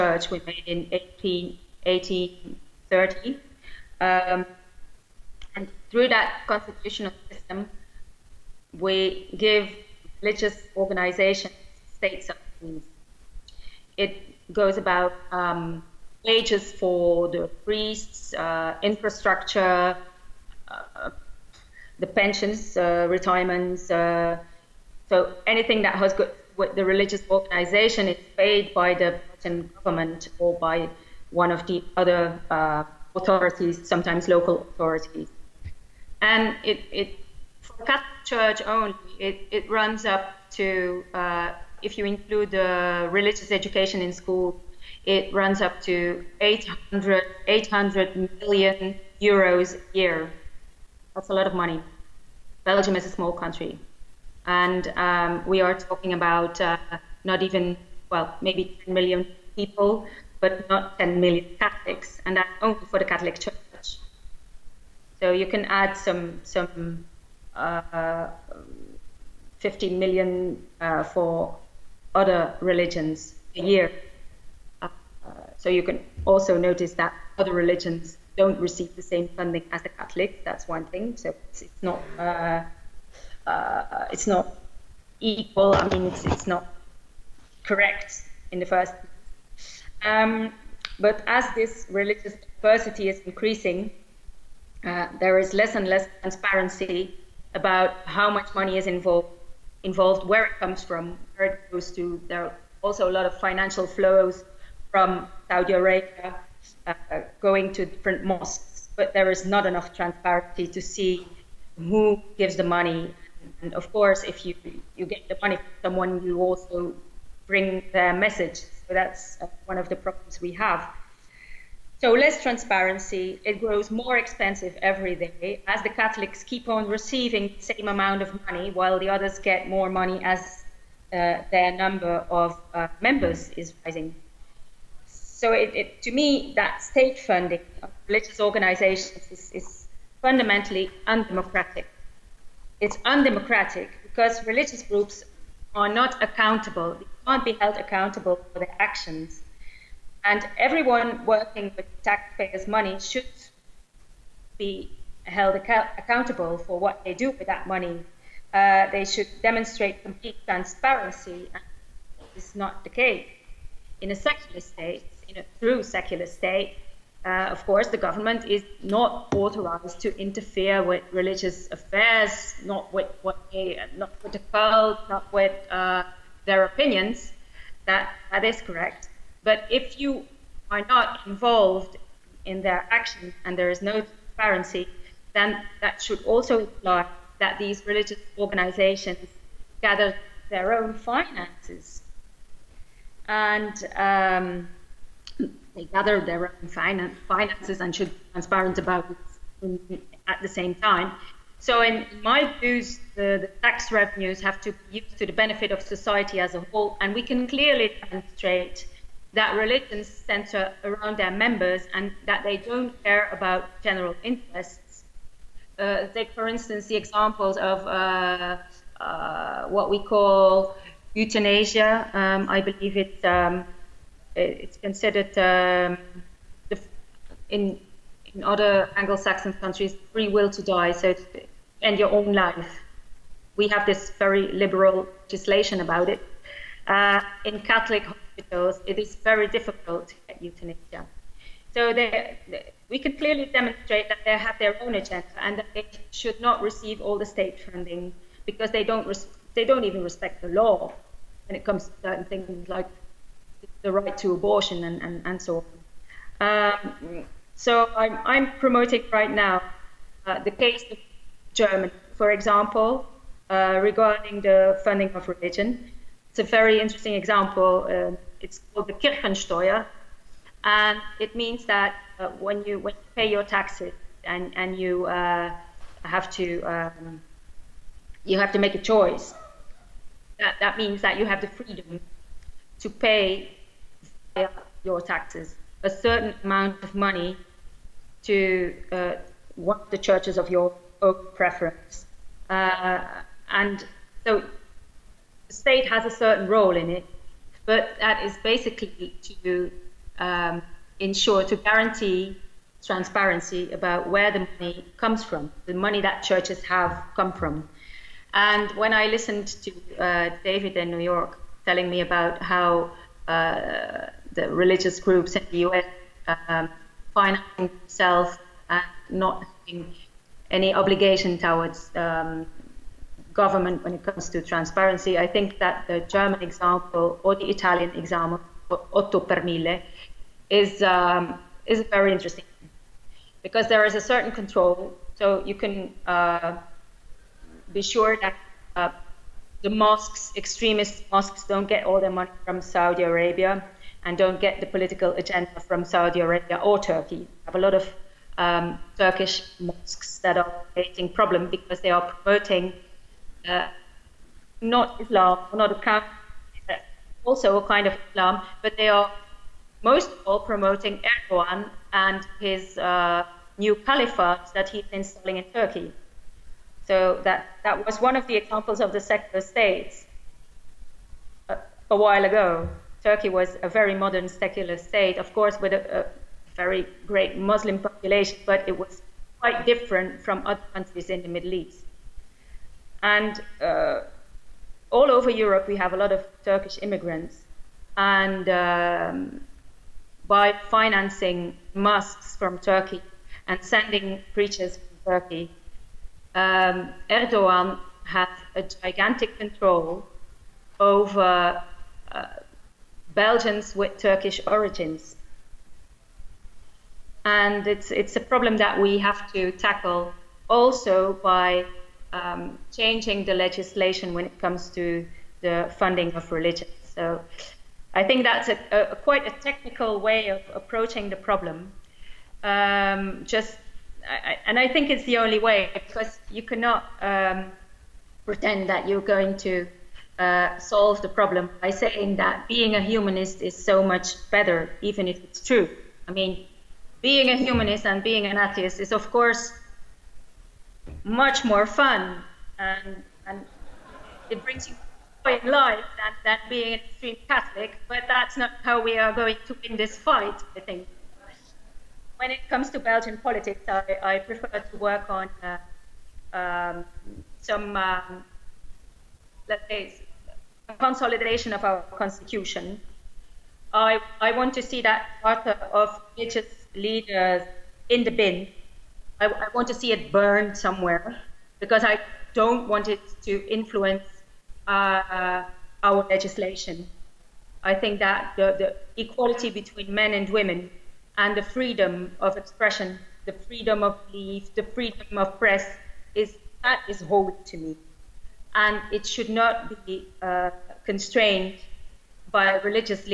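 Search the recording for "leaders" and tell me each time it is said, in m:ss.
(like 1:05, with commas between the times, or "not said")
7:46.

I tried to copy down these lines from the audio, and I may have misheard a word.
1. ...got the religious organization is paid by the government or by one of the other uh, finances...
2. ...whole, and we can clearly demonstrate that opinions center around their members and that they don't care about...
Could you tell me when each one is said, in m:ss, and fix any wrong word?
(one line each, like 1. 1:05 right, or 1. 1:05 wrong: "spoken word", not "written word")
1. 0:26 wrong: "authorities", not "finances"
2. 3:26 wrong: "religions", not "opinions".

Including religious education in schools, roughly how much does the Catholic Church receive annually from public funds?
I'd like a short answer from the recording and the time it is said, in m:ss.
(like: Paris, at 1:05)
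800 million euros, at 0:47.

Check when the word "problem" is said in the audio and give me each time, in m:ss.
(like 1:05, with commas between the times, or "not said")
1:59, 5:51, 6:48, 7:01, 7:11.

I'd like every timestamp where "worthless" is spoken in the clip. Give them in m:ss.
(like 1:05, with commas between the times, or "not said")
not said.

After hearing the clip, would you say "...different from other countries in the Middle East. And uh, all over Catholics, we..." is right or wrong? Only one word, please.
wrong.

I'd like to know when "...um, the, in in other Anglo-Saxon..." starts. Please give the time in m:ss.
3:45.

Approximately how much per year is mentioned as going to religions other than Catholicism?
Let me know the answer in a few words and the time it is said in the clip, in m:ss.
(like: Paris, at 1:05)
15 million, at 1:09.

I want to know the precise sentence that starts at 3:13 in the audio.
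And um, they gather their own finances and should be transparent about it at the same time.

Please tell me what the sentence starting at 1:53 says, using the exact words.
And of course, if you, you get the money from someone, you also bring their message.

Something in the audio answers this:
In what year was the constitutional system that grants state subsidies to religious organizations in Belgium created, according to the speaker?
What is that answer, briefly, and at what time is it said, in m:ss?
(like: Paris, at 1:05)
1830, at 0:00.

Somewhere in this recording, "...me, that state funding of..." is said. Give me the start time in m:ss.
2:16.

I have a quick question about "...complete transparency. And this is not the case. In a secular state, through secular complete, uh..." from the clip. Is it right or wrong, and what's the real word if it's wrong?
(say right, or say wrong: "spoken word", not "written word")
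wrong: "state", not "complete".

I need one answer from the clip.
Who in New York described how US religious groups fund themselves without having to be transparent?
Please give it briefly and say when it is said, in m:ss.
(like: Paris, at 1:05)
David, at 5:10.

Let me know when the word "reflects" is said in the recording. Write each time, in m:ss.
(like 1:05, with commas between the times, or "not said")
not said.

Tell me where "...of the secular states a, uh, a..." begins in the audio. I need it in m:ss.
6:08.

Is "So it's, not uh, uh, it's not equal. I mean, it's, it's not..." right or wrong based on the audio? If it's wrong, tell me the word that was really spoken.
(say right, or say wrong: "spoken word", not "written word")
right.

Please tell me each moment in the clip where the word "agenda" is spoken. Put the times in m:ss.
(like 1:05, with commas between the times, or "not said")
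4:04, 5:45.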